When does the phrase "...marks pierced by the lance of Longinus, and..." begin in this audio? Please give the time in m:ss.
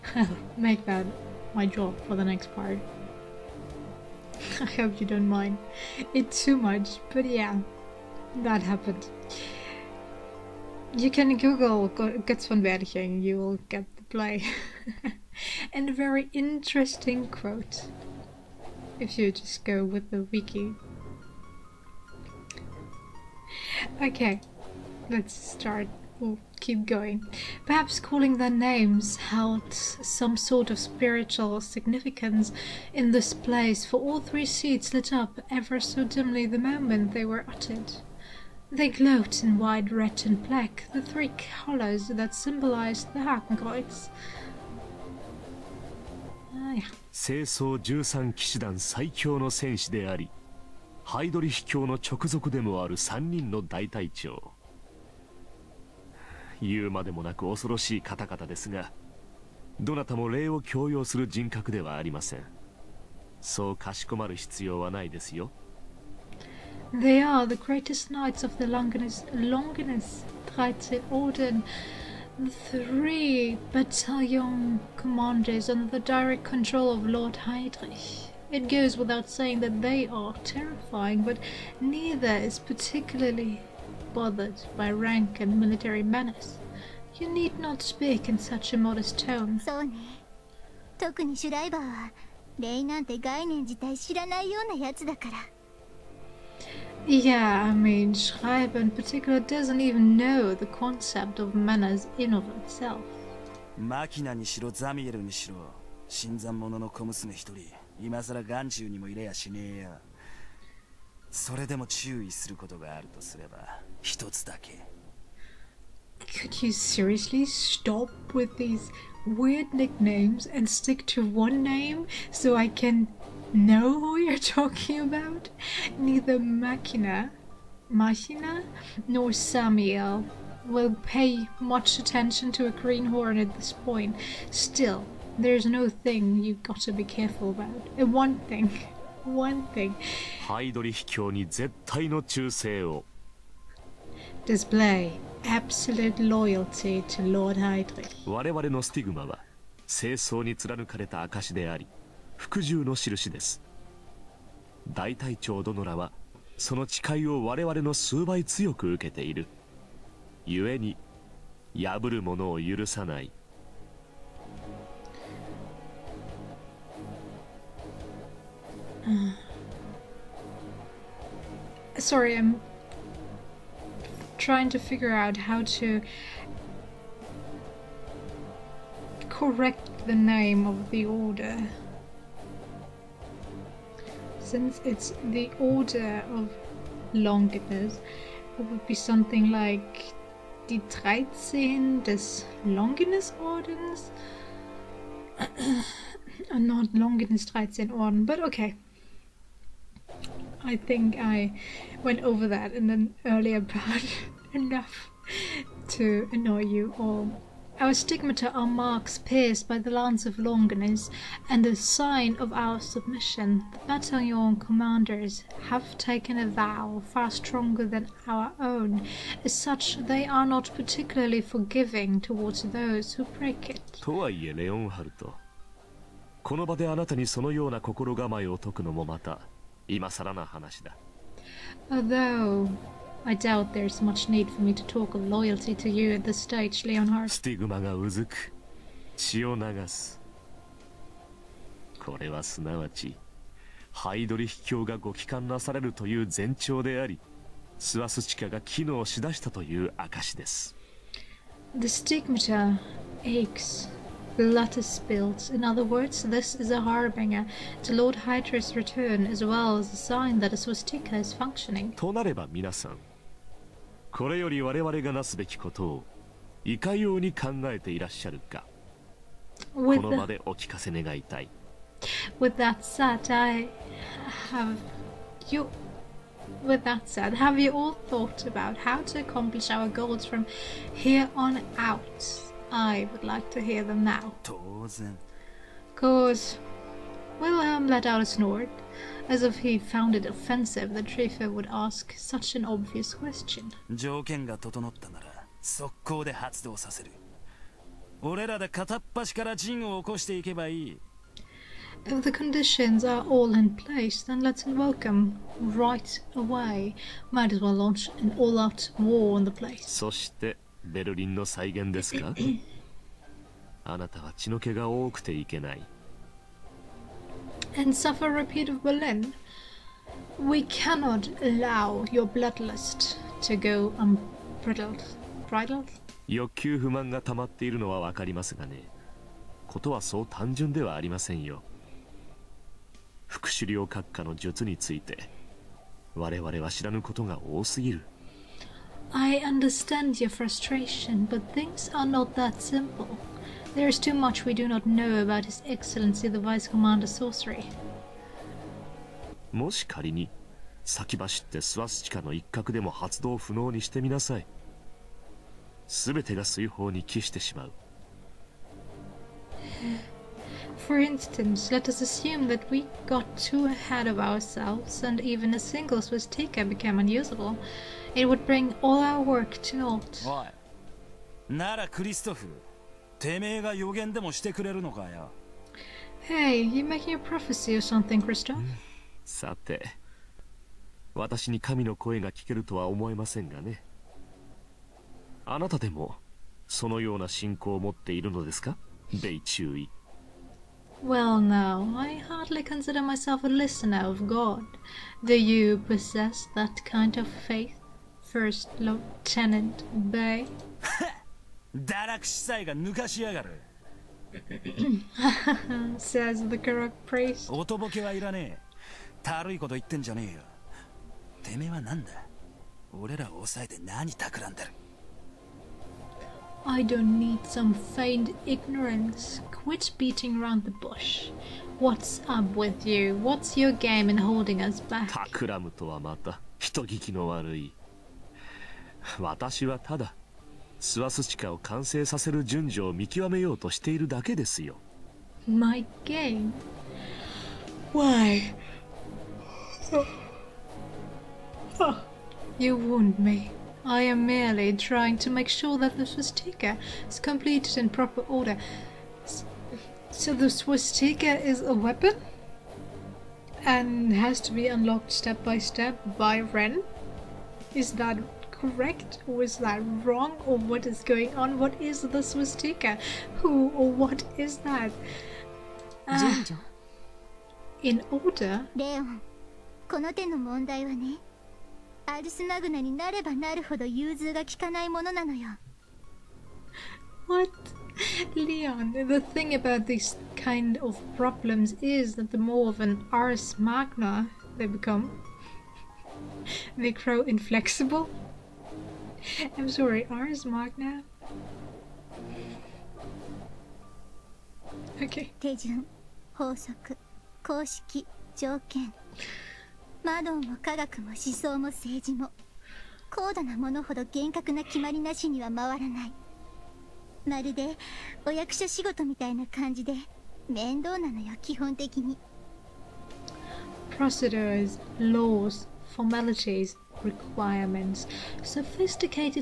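3:28.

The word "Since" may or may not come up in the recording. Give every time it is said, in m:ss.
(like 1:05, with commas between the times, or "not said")
3:04.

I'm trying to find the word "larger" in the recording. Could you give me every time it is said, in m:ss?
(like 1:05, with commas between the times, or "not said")
not said.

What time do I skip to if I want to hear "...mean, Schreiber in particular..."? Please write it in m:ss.
1:37.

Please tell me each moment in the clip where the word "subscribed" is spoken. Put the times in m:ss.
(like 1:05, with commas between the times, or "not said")
not said.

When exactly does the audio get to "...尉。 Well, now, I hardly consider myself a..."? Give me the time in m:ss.
6:29.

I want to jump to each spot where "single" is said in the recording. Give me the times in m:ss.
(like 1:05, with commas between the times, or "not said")
6:05.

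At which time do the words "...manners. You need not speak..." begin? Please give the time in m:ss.
1:26.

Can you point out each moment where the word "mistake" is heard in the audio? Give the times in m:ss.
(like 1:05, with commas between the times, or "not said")
7:42.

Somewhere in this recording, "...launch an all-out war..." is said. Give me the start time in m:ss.
5:07.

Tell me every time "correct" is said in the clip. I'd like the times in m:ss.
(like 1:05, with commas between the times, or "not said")
2:59, 7:38.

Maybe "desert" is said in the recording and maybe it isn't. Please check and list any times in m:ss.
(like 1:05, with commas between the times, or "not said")
not said.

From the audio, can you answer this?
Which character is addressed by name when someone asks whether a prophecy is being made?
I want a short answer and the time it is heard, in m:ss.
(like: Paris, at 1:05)
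Christoph, at 6:18.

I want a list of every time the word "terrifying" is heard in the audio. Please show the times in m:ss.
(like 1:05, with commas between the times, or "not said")
1:20.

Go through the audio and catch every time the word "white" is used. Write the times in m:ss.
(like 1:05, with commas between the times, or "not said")
0:39.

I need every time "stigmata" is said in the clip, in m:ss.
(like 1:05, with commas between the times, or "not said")
3:27, 4:11.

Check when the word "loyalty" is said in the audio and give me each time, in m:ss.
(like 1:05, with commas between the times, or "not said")
2:26, 3:55.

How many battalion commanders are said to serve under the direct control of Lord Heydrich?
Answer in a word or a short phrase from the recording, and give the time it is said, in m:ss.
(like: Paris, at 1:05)
3, at 1:12.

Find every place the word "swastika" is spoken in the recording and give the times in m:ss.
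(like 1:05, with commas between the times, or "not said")
4:20, 7:26, 7:30.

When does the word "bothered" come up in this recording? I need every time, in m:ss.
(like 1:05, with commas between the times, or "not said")
1:24.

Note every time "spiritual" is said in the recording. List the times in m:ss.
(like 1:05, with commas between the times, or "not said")
0:30.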